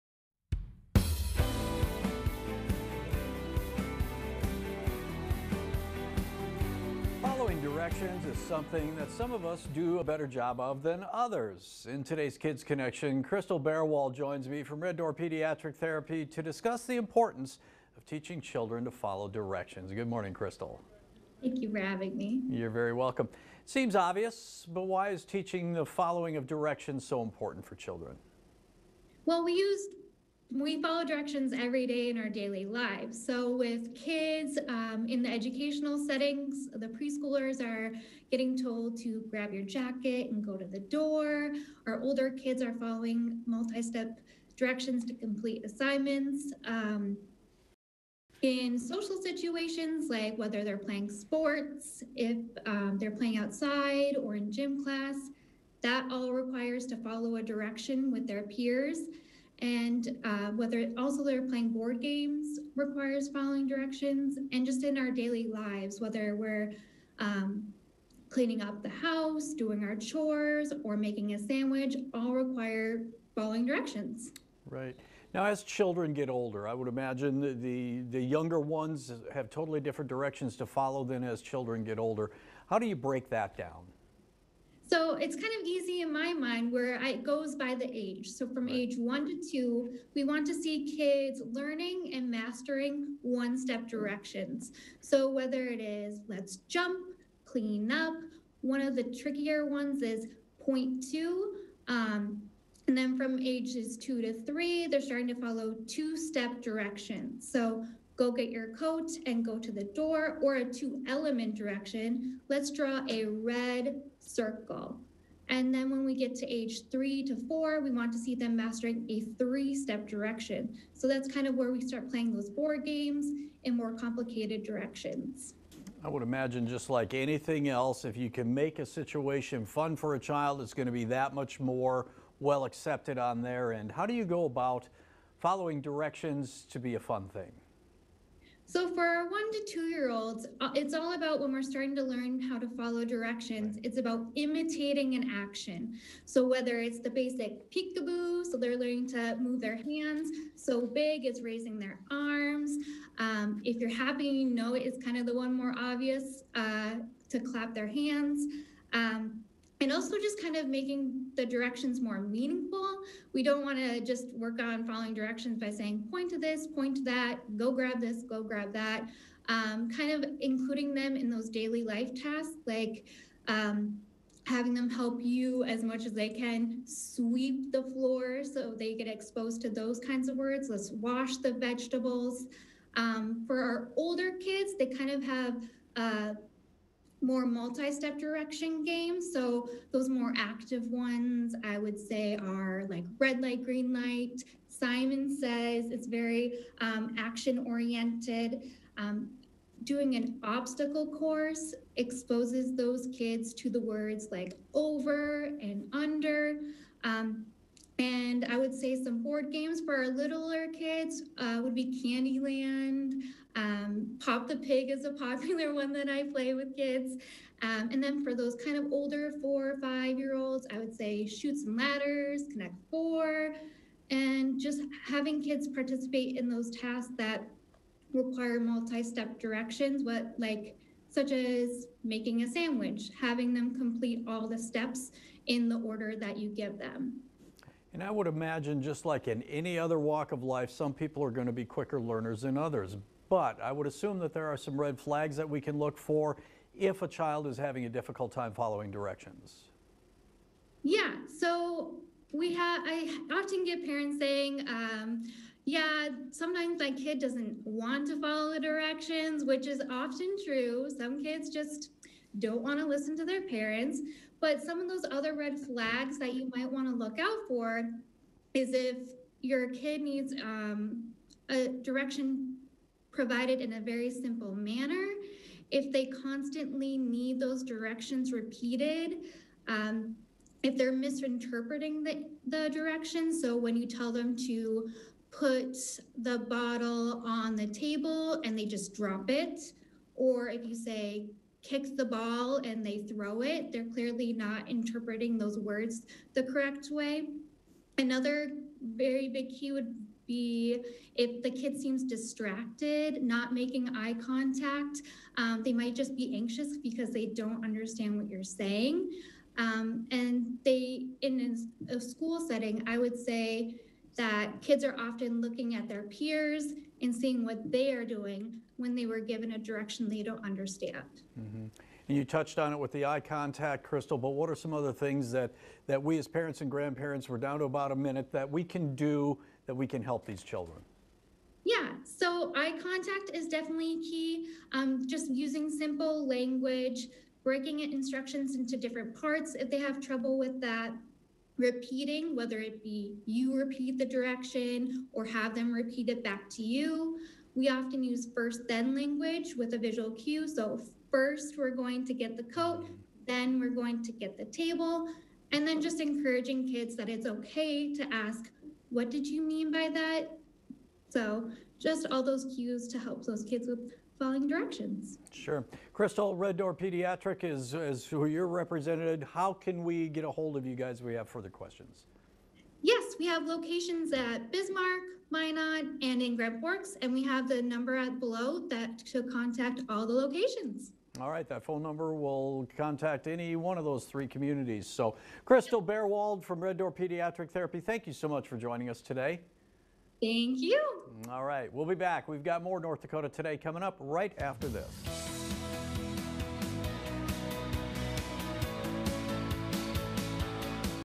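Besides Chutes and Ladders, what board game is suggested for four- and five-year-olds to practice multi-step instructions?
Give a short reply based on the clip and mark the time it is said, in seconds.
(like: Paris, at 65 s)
Connect Four, at 222 s.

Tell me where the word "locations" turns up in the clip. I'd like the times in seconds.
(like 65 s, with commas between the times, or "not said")
373 s, 380 s.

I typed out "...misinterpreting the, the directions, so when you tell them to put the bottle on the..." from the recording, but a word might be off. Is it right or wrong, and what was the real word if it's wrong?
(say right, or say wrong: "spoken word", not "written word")
right.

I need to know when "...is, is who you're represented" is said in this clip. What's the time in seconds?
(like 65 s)
367 s.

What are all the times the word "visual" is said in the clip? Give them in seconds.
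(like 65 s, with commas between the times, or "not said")
349 s.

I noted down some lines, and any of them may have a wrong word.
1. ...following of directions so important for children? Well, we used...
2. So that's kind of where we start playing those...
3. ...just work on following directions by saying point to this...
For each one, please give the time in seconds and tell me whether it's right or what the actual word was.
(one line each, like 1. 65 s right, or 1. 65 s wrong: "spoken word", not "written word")
1. 25 s right
2. 120 s right
3. 164 s right.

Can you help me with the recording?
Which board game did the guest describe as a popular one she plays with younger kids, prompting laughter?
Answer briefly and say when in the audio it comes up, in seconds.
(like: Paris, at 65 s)
Pop the Pig, at 214 s.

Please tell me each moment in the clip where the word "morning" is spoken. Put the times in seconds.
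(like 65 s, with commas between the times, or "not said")
20 s.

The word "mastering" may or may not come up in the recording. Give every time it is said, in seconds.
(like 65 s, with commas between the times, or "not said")
92 s, 118 s.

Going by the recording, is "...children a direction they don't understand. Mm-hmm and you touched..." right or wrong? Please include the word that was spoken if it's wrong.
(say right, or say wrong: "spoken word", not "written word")
wrong: "given", not "children".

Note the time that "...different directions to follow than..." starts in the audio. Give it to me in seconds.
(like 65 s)
79 s.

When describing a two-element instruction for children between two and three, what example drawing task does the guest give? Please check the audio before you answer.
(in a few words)
Draw a red circle.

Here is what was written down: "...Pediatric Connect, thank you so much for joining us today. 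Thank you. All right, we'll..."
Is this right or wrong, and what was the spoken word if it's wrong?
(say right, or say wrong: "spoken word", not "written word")
wrong: "Therapy", not "Connect".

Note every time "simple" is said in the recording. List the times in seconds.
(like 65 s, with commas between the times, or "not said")
274 s, 335 s.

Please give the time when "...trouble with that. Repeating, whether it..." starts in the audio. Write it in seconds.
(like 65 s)
340 s.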